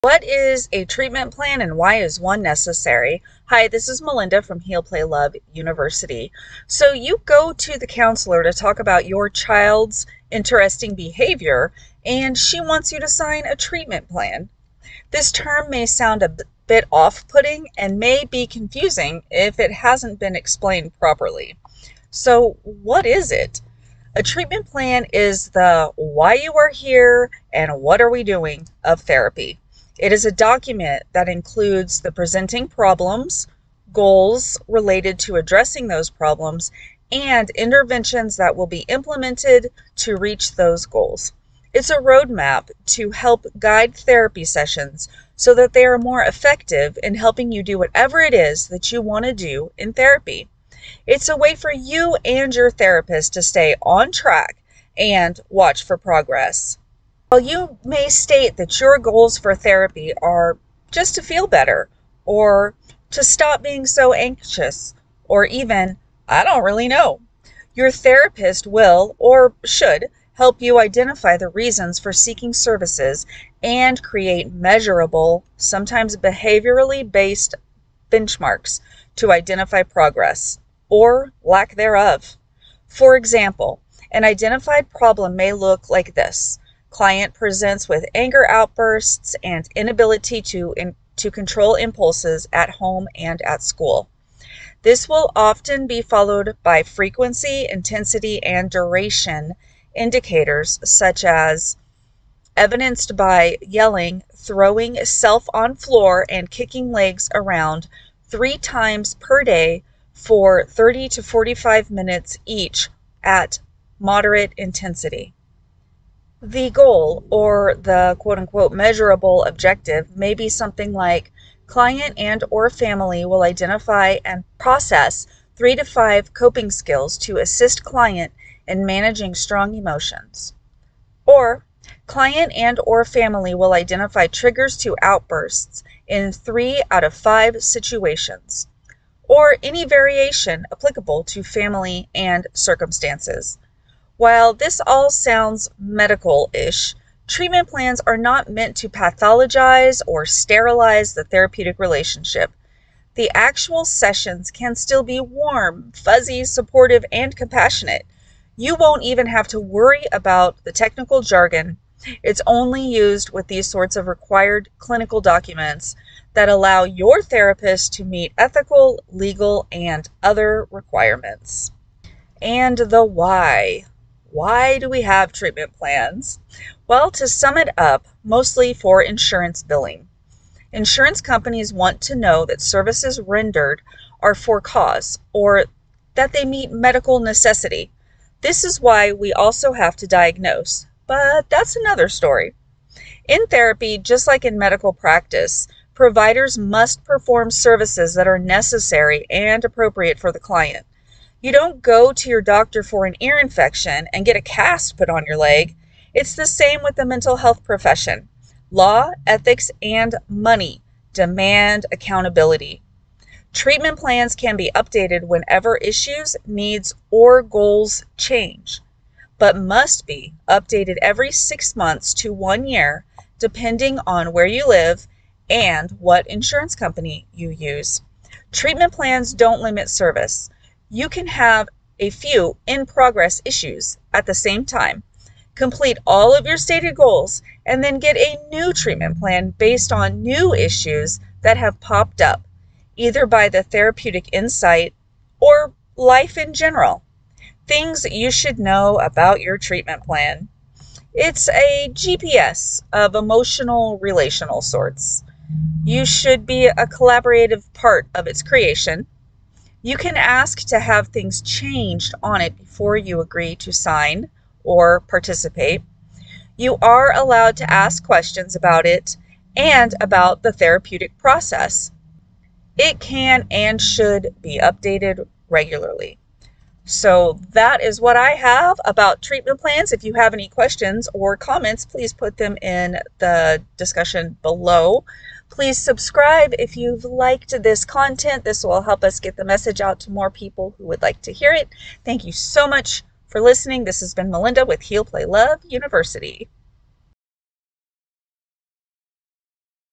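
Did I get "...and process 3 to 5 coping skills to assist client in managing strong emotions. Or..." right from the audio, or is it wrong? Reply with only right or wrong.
right.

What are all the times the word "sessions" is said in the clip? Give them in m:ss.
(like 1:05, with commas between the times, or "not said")
0:44, 2:33.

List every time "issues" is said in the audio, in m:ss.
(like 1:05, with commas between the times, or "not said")
3:35, 3:53, 4:00.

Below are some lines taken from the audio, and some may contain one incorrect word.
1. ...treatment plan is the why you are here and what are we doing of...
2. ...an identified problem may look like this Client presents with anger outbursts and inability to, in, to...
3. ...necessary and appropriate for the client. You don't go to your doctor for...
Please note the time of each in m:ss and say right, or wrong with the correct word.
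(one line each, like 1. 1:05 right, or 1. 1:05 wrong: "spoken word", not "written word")
1. 0:24 right
2. 1:24 right
3. 3:18 right.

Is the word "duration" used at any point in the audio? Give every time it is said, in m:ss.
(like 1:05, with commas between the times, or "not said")
1:38.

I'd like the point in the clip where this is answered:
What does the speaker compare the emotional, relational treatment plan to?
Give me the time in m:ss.
4:11.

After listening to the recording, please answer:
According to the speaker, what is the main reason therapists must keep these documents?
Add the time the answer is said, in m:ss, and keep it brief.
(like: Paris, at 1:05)
Insurance billing, at 2:59.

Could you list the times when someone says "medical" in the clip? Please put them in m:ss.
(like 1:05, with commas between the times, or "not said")
2:25, 3:06, 3:14.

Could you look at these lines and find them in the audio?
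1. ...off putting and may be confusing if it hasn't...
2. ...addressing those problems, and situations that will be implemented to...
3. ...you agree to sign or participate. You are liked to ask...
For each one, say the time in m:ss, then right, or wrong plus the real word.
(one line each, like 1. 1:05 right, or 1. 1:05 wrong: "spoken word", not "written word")
1. 0:16 right
2. 0:35 wrong: "interventions", not "situations"
3. 4:22 wrong: "allowed", not "liked".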